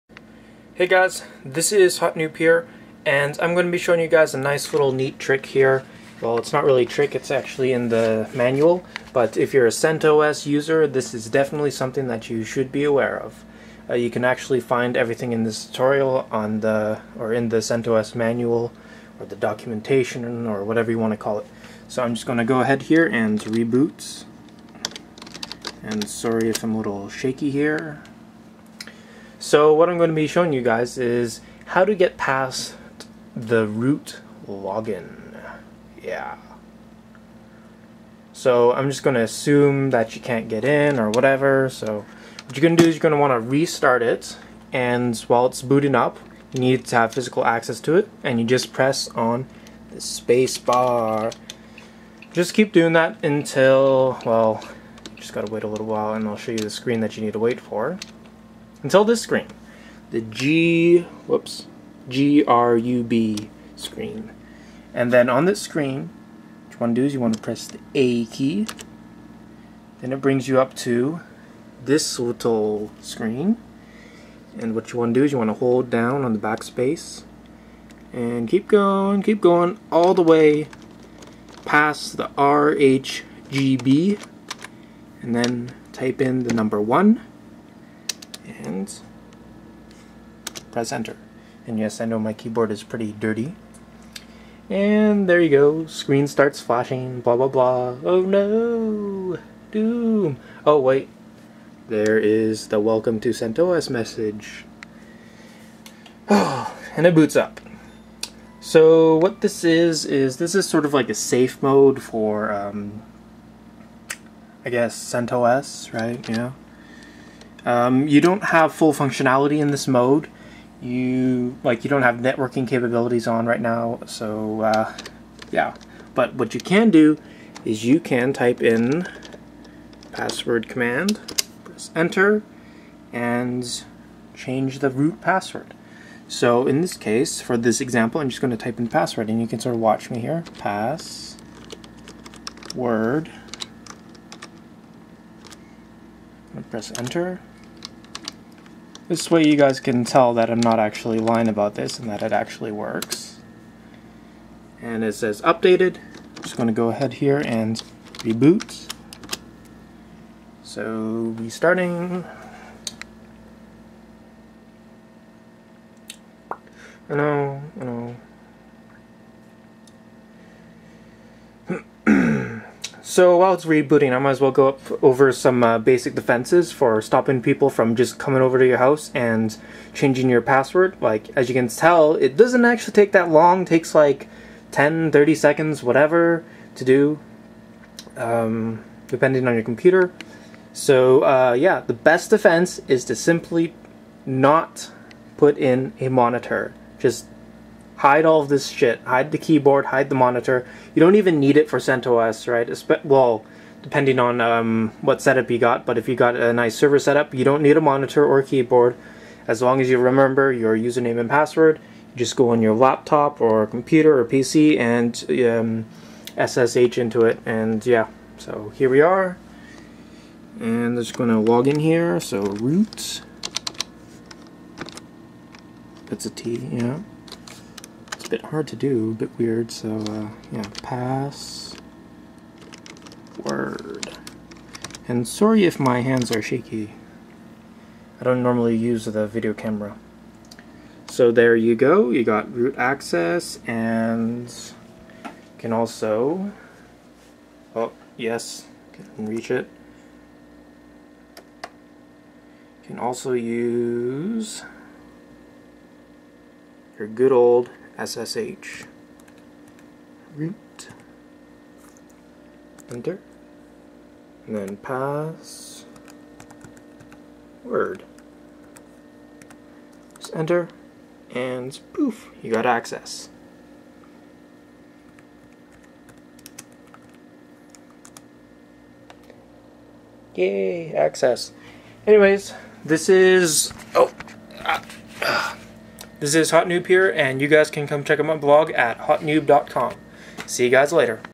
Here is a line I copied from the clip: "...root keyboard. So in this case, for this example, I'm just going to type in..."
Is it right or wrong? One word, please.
wrong.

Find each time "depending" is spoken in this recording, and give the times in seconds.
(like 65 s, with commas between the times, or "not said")
189 s, 203 s.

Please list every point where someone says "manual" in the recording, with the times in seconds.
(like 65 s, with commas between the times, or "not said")
8 s, 18 s.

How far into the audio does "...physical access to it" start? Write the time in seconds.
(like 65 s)
47 s.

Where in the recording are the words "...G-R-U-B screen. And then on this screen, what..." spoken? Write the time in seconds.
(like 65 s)
62 s.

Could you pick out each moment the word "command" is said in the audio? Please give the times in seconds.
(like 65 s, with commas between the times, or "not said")
130 s.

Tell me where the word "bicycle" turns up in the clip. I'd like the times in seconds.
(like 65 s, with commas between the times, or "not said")
not said.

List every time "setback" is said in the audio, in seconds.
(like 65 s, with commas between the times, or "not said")
not said.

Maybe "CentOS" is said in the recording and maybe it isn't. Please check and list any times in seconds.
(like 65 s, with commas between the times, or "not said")
9 s, 17 s, 103 s, 114 s, 201 s.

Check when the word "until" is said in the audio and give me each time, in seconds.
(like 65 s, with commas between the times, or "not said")
53 s, 58 s.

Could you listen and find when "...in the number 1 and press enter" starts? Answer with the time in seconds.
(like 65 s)
86 s.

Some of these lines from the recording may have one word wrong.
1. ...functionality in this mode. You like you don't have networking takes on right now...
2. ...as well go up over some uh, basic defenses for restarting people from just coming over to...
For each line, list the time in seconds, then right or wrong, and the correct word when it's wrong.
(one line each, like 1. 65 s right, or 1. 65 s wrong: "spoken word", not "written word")
1. 118 s wrong: "capabilities", not "takes"
2. 174 s wrong: "stopping", not "restarting".